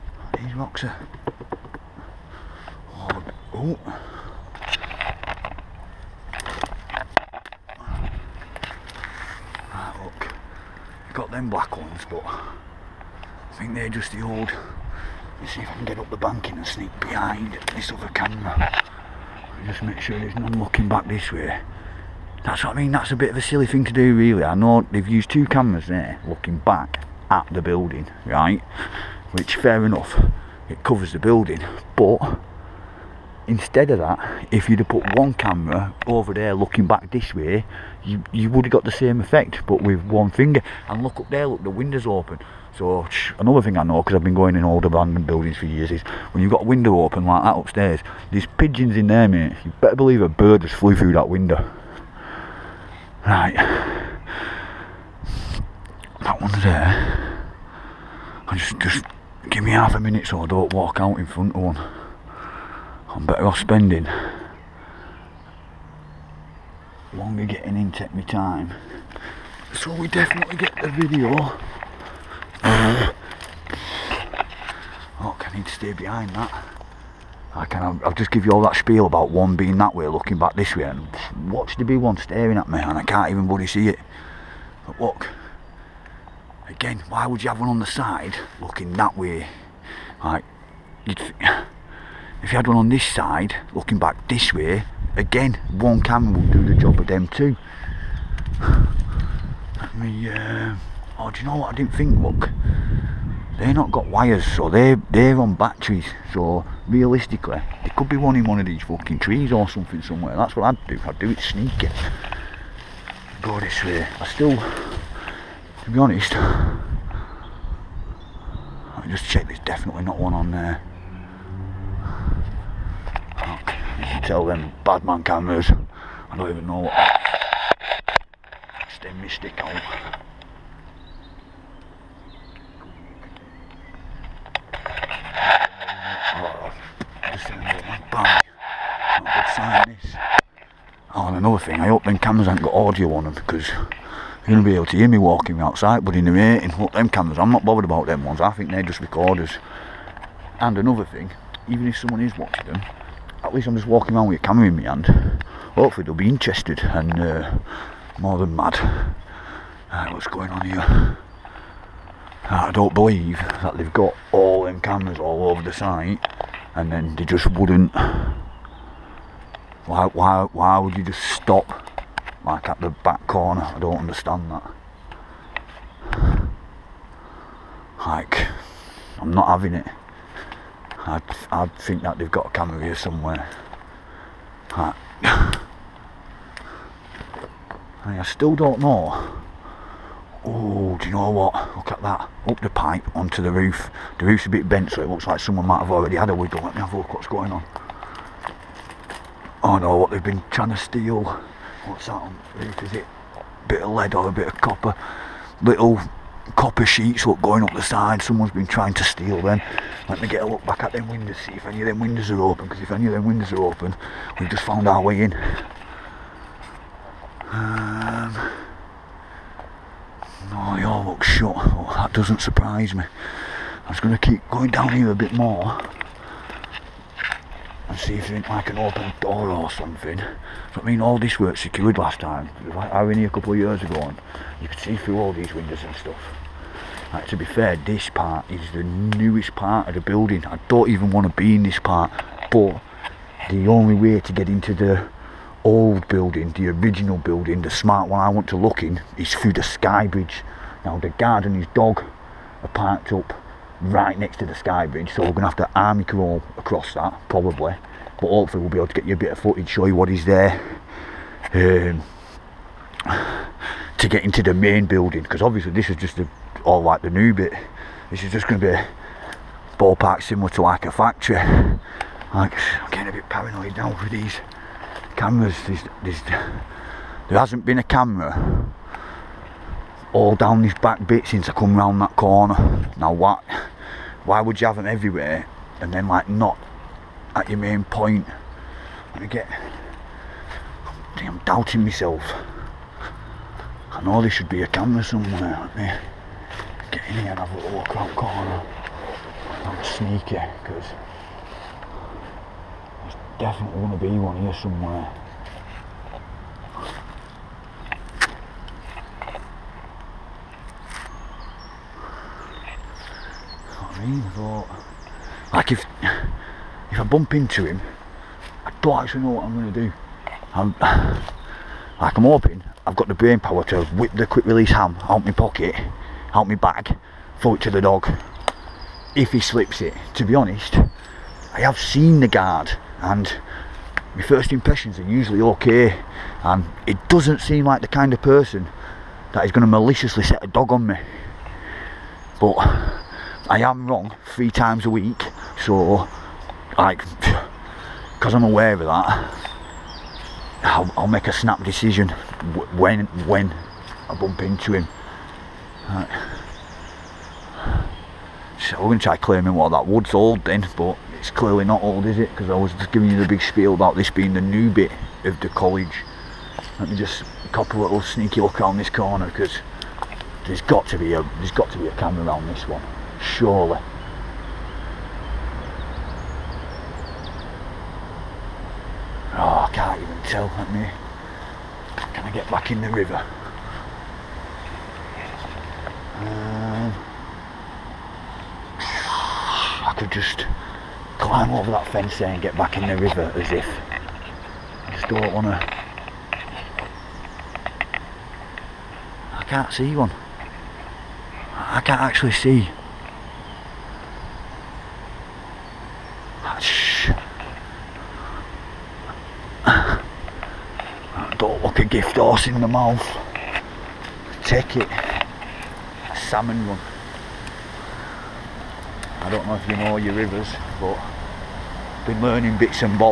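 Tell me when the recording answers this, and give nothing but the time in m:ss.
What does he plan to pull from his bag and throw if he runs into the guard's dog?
5:24.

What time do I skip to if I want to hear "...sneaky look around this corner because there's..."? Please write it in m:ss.
6:07.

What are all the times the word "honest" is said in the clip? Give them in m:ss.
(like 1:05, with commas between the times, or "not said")
1:55, 5:30.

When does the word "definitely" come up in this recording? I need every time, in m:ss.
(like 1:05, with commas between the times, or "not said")
1:10, 1:59, 5:03.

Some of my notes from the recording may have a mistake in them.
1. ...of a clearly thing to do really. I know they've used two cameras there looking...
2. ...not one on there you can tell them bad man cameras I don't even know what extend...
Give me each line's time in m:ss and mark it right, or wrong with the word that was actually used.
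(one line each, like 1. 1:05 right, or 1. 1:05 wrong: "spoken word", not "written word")
1. 0:23 wrong: "silly", not "clearly"
2. 2:00 right.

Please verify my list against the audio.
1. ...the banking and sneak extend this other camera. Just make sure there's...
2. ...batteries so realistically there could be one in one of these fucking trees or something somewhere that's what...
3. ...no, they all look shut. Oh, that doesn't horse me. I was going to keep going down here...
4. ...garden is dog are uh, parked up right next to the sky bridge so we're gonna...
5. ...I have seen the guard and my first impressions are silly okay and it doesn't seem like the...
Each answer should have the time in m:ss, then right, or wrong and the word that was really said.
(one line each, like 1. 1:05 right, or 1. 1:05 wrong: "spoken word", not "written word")
1. 0:16 wrong: "behind", not "extend"
2. 1:45 right
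3. 3:40 wrong: "surprise", not "horse"
4. 4:11 right
5. 5:31 wrong: "usually", not "silly".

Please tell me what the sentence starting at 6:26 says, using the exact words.
Um, I could just climb over that fence there and get back in the river as if.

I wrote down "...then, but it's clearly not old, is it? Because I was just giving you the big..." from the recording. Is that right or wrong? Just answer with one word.
right.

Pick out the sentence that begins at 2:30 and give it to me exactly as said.
And another thing, even if someone is watching them, at least I'm just walking around with a camera in my hand.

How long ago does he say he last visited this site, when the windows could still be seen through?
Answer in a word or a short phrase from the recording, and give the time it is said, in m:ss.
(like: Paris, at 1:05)
A couple of years ago, at 3:53.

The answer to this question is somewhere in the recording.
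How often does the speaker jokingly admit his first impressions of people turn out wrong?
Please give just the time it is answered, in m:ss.
5:44.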